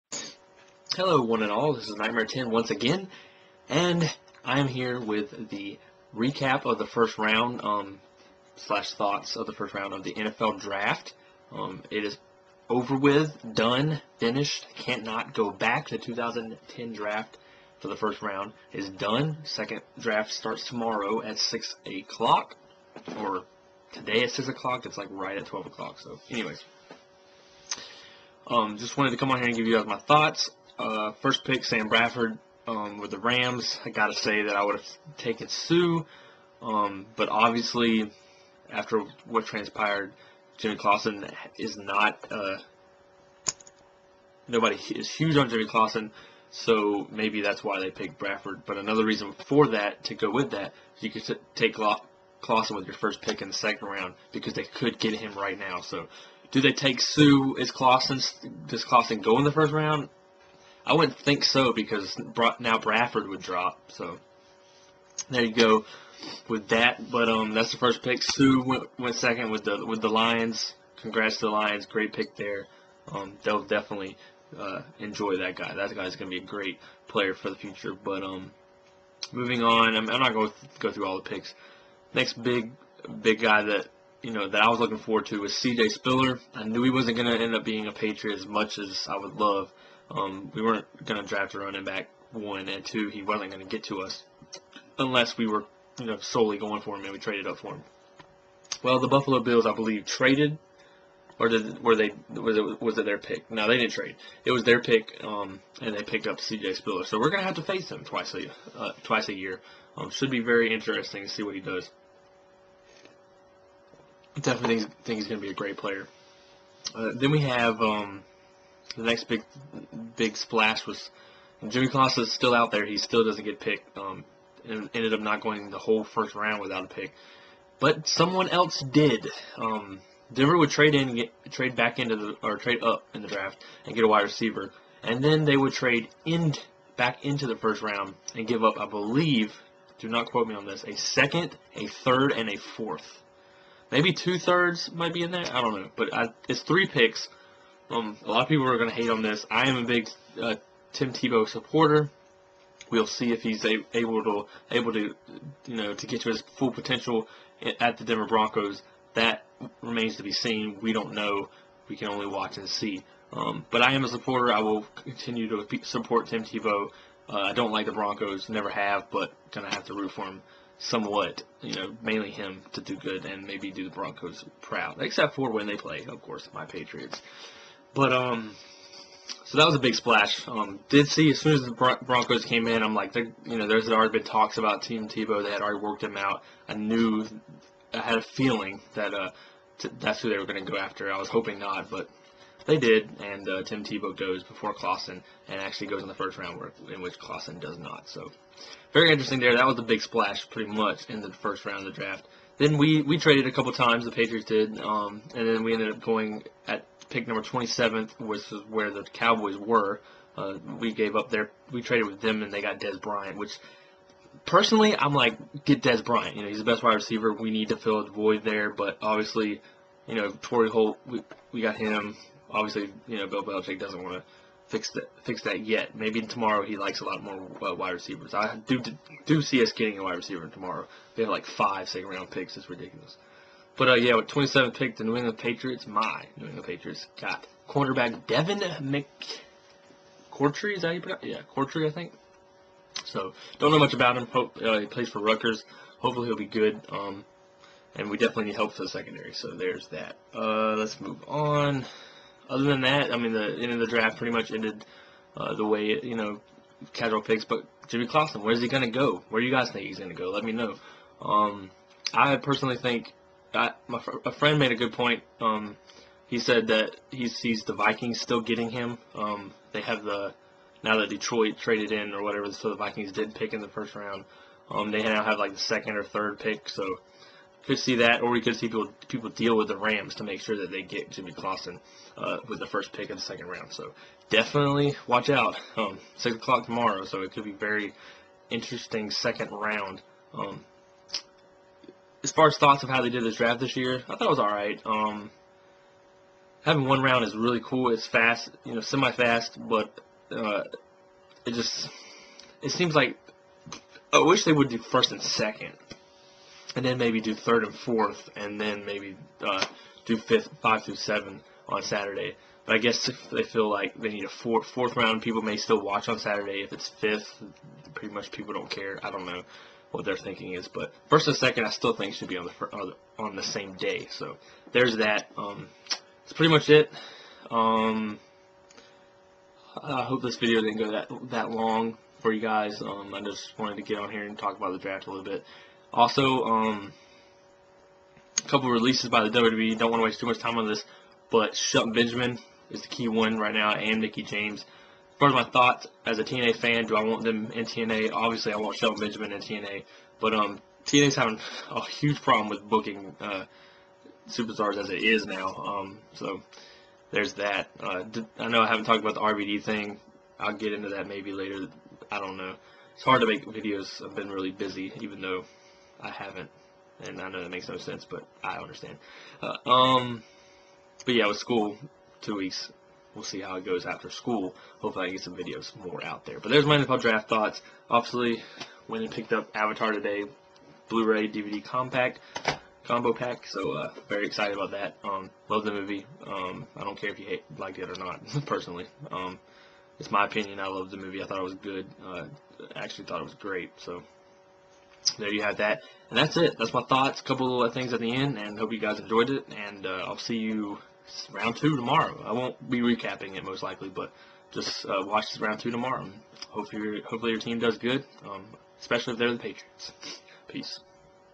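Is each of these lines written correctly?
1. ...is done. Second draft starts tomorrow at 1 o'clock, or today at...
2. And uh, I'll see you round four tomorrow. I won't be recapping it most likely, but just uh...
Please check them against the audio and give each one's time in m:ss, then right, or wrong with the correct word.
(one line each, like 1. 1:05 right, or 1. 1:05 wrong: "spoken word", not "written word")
1. 0:18 wrong: "6", not "1"
2. 6:39 wrong: "two", not "four".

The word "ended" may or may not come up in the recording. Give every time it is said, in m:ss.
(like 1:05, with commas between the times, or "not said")
2:04, 3:25, 4:14.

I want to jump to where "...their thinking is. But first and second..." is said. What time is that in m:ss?
5:20.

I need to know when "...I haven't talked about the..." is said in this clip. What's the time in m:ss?
5:58.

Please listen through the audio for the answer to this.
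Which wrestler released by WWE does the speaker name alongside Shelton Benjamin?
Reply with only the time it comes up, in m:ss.
5:44.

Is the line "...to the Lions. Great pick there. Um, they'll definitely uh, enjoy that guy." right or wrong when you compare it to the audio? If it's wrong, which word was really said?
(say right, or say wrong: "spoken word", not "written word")
right.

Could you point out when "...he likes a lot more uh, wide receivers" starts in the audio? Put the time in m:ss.
3:46.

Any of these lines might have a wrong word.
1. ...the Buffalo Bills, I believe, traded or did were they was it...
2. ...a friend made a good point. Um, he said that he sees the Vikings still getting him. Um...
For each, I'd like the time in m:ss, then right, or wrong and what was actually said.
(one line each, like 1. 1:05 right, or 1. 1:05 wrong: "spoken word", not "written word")
1. 1:38 right
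2. 4:24 right.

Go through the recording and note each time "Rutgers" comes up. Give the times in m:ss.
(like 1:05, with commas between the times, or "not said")
4:05.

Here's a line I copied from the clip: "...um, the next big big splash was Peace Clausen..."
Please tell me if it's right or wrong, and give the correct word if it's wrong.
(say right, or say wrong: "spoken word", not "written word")
wrong: "Jimmy", not "Peace".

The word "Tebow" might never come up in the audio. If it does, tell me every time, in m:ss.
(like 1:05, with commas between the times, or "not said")
2:31, 2:46, 3:05, 3:13.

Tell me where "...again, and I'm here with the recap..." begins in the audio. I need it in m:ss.
0:02.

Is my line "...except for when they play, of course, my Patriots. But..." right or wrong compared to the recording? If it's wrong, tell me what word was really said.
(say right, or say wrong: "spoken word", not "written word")
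right.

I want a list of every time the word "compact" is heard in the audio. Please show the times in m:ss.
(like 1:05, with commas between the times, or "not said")
6:21.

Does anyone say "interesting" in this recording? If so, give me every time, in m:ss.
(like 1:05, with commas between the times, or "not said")
1:50, 3:19, 4:48.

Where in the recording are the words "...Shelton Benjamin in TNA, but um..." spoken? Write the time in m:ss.
5:48.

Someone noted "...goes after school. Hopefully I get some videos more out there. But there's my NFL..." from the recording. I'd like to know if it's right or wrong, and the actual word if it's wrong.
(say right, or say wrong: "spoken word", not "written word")
right.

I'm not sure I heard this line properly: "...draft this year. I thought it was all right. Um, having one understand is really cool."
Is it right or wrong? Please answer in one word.
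wrong.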